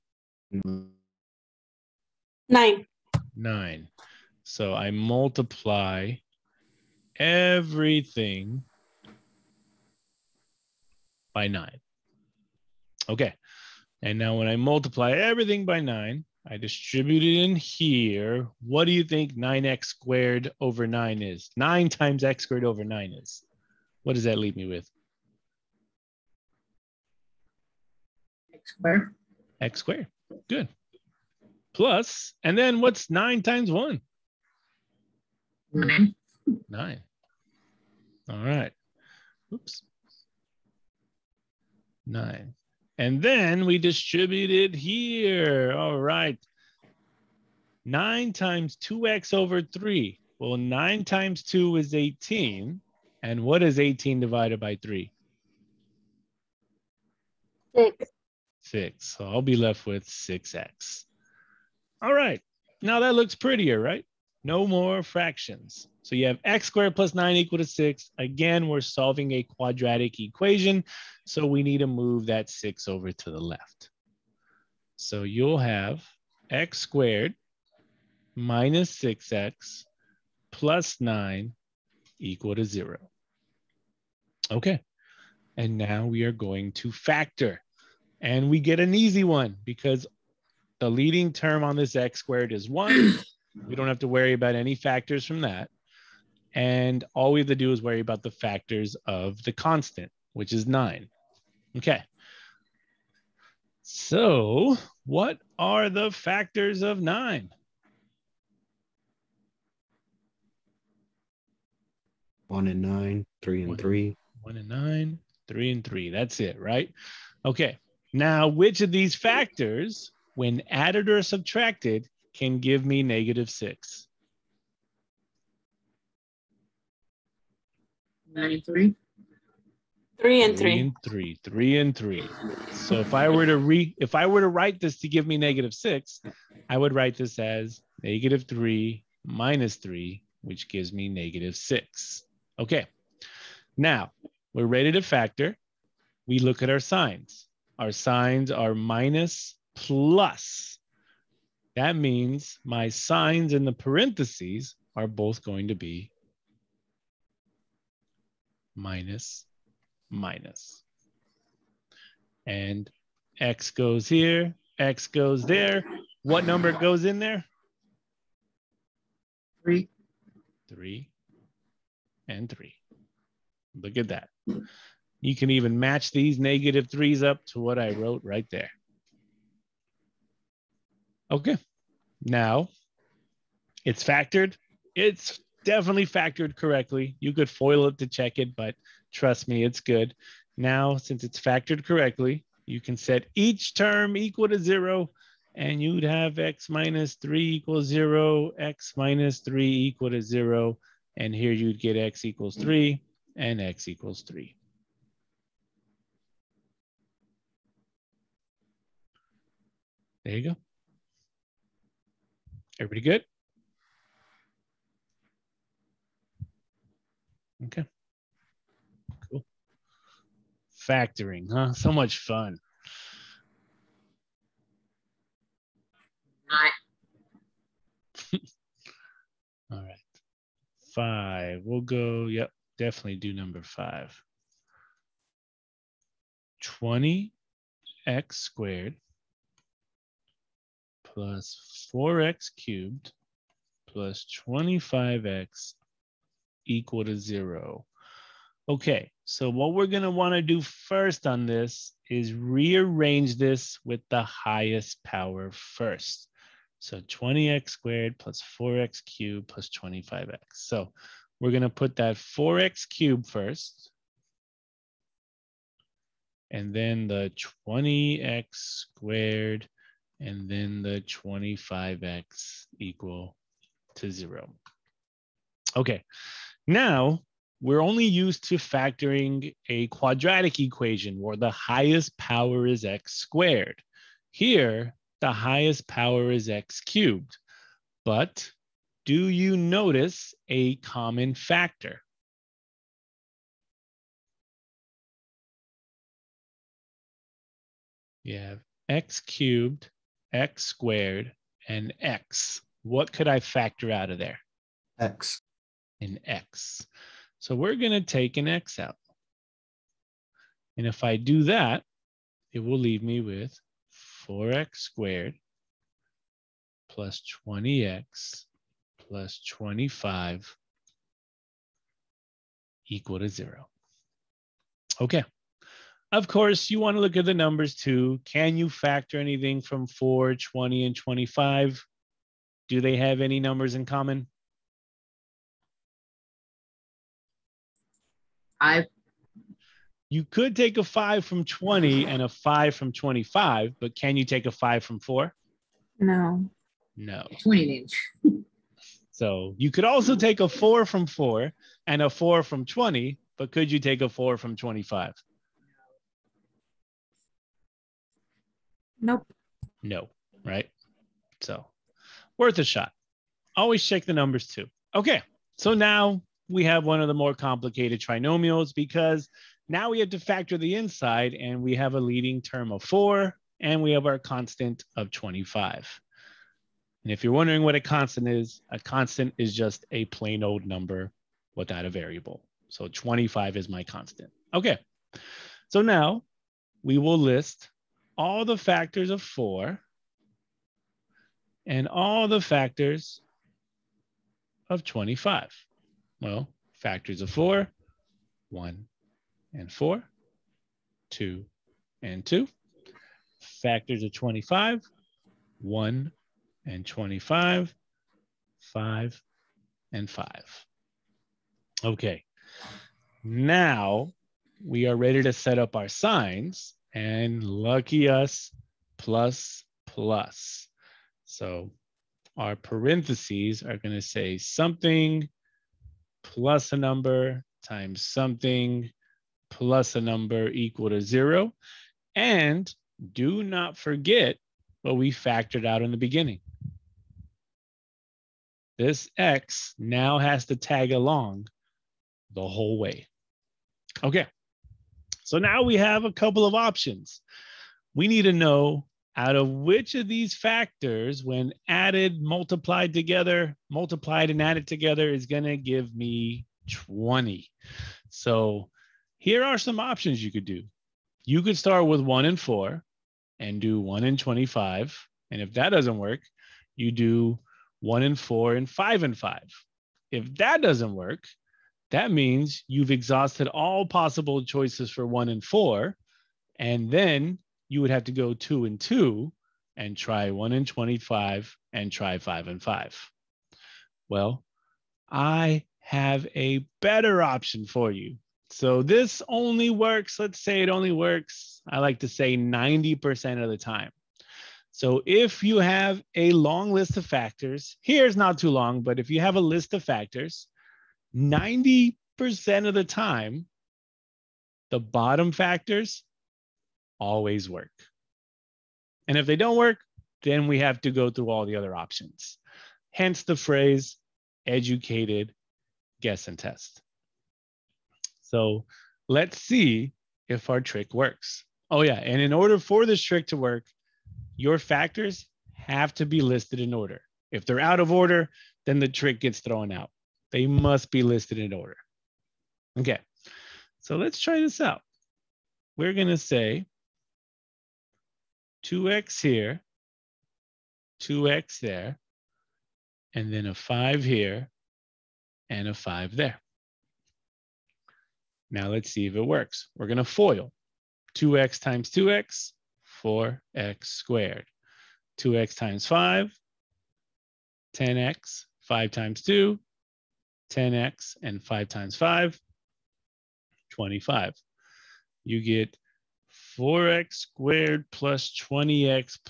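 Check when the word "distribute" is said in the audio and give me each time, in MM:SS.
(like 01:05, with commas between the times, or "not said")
00:16, 00:43.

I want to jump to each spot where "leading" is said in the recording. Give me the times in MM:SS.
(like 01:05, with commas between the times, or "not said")
01:30, 06:11.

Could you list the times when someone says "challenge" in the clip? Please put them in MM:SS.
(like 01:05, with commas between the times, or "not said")
not said.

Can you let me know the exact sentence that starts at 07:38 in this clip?
So here are some options you could do.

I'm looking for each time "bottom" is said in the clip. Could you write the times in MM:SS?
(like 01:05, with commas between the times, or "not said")
08:24.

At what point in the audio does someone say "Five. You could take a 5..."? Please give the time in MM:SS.
05:38.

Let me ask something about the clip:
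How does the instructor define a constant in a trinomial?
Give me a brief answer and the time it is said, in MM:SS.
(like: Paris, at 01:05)
a plain old number without a variable, at 06:19.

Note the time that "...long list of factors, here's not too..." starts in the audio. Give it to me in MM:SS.
08:16.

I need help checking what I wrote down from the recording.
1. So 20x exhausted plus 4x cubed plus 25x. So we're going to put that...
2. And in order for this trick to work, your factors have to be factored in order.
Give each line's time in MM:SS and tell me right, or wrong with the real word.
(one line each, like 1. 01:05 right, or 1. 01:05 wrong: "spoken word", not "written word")
1. 04:16 wrong: "squared", not "exhausted"
2. 08:41 wrong: "listed", not "factored".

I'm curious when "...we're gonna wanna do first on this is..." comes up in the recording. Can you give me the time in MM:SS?
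04:09.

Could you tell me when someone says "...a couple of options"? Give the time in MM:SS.
07:26.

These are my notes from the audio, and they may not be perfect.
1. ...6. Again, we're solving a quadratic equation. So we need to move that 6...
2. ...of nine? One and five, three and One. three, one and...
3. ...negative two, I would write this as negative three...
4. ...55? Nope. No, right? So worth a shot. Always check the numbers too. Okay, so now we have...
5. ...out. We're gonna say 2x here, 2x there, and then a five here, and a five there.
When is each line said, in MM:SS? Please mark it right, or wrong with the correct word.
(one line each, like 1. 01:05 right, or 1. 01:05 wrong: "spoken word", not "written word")
1. 01:07 right
2. 01:46 wrong: "nine", not "five"
3. 02:15 wrong: "six", not "two"
4. 05:54 wrong: "25", not "55"
5. 08:54 right.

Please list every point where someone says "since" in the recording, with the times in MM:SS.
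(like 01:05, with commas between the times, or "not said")
03:10.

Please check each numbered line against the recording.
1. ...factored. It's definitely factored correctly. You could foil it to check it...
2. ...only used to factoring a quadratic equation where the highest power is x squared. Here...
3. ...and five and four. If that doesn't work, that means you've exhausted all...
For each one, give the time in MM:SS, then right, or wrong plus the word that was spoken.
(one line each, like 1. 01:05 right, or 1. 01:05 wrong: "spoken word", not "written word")
1. 03:04 right
2. 04:37 right
3. 07:48 wrong: "five", not "four".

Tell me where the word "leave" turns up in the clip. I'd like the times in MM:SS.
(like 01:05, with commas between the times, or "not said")
00:24, 05:12.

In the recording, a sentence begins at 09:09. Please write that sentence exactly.
We're gonna foil 2x times 2x 4x squared.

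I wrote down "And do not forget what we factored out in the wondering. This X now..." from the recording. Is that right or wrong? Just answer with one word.
wrong.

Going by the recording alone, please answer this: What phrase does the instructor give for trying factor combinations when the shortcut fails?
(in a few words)
educated guess and test.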